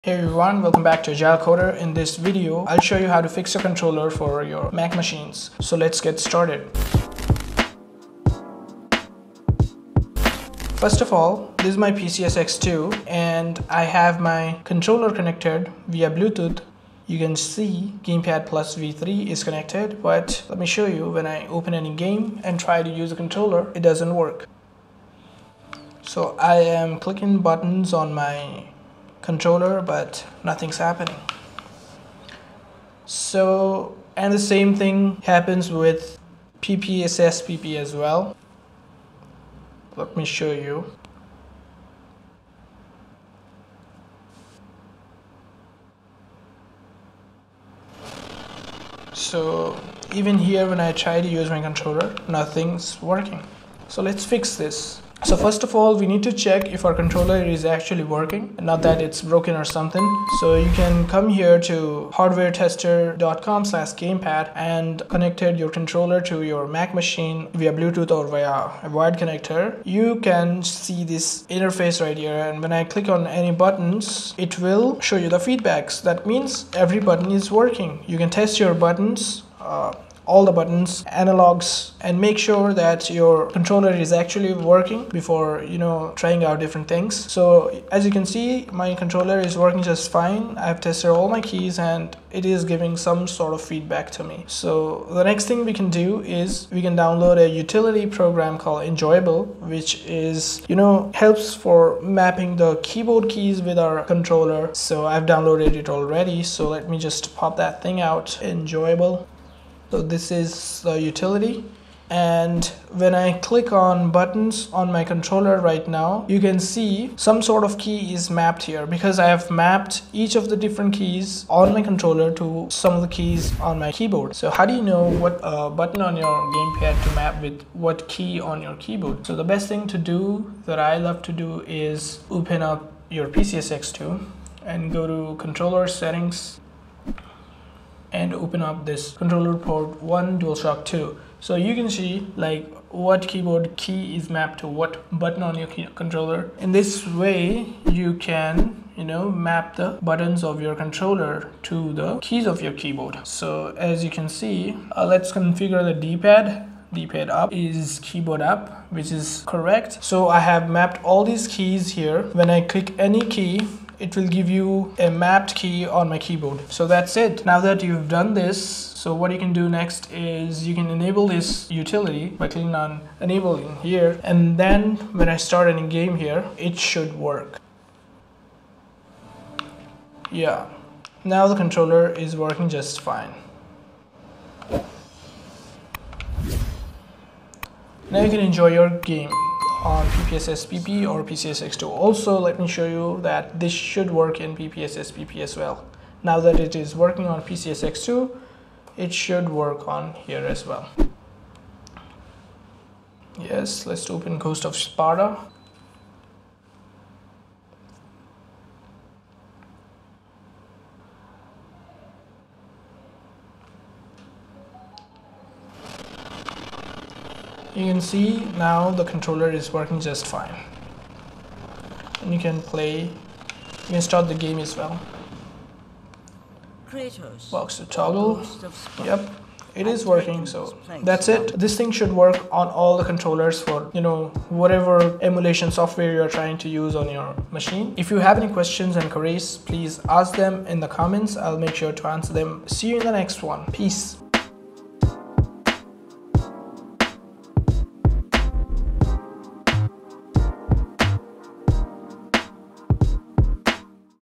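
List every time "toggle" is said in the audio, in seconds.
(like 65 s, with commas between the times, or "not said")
227 s.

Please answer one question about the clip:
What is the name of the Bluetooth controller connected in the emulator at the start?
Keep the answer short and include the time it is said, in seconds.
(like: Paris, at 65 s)
Gamepad Plus V3, at 18 s.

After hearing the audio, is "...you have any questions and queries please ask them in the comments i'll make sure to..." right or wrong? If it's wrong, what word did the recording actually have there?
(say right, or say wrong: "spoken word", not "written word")
right.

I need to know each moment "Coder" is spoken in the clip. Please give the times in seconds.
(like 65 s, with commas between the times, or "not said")
1 s.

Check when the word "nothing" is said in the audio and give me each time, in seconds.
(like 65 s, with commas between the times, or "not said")
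30 s, 52 s.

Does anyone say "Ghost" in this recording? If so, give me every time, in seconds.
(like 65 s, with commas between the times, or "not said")
204 s.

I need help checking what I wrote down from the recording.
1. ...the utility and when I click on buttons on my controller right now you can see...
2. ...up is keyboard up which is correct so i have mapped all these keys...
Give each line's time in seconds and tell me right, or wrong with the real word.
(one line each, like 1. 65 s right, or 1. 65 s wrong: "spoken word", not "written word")
1. 110 s right
2. 157 s right.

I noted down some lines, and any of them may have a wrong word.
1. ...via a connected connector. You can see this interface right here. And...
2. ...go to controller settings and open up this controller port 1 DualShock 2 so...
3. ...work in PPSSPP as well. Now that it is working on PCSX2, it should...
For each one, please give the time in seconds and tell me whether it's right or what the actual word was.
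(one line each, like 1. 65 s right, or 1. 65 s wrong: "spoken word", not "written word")
1. 68 s wrong: "wired", not "connected"
2. 134 s right
3. 194 s right.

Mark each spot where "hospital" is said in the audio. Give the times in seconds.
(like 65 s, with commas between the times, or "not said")
not said.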